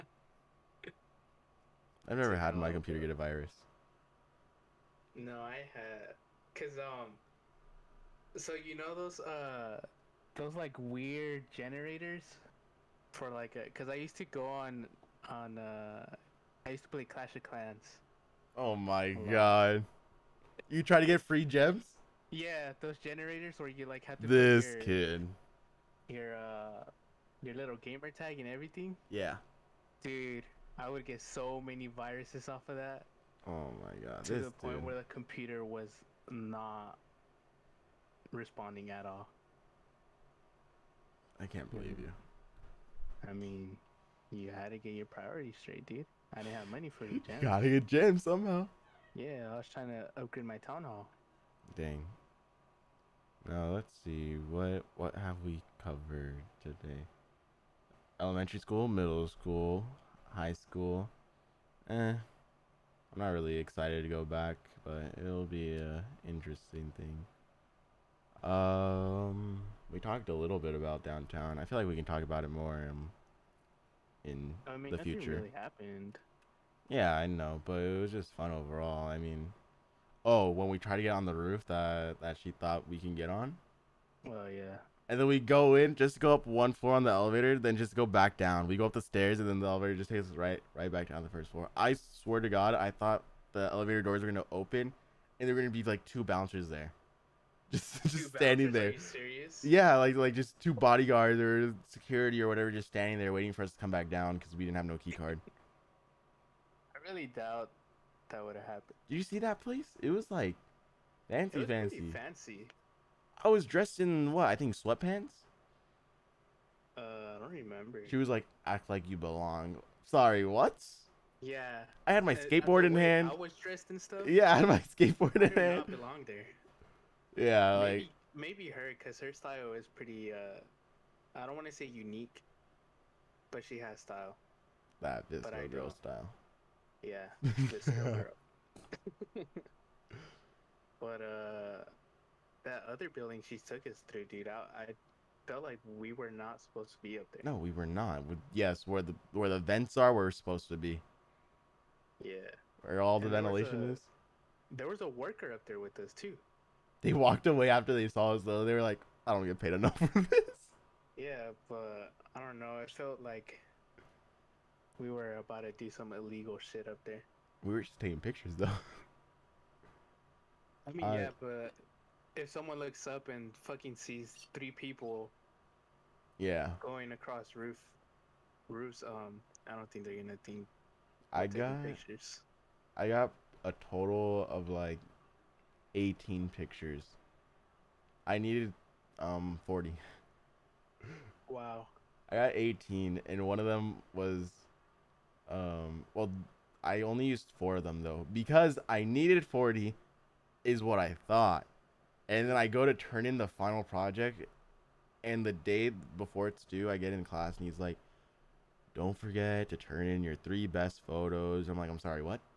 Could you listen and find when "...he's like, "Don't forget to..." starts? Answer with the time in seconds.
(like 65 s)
207 s.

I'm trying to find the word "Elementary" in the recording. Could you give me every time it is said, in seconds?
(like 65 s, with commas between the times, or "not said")
58 s.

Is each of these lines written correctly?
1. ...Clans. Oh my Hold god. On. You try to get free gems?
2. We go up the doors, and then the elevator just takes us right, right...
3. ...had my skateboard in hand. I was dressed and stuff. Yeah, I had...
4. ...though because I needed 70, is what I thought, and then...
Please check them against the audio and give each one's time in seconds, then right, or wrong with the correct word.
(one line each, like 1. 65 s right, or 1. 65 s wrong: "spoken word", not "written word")
1. 17 s right
2. 88 s wrong: "stairs", not "doors"
3. 122 s right
4. 198 s wrong: "40", not "70".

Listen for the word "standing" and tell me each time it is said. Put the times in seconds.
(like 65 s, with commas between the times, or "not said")
98 s, 102 s.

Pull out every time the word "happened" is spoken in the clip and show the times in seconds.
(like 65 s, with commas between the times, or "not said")
75 s, 108 s.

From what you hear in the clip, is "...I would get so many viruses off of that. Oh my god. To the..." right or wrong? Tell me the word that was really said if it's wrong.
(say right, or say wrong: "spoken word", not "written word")
right.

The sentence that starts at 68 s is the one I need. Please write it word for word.
Um, we talked a little bit about downtown.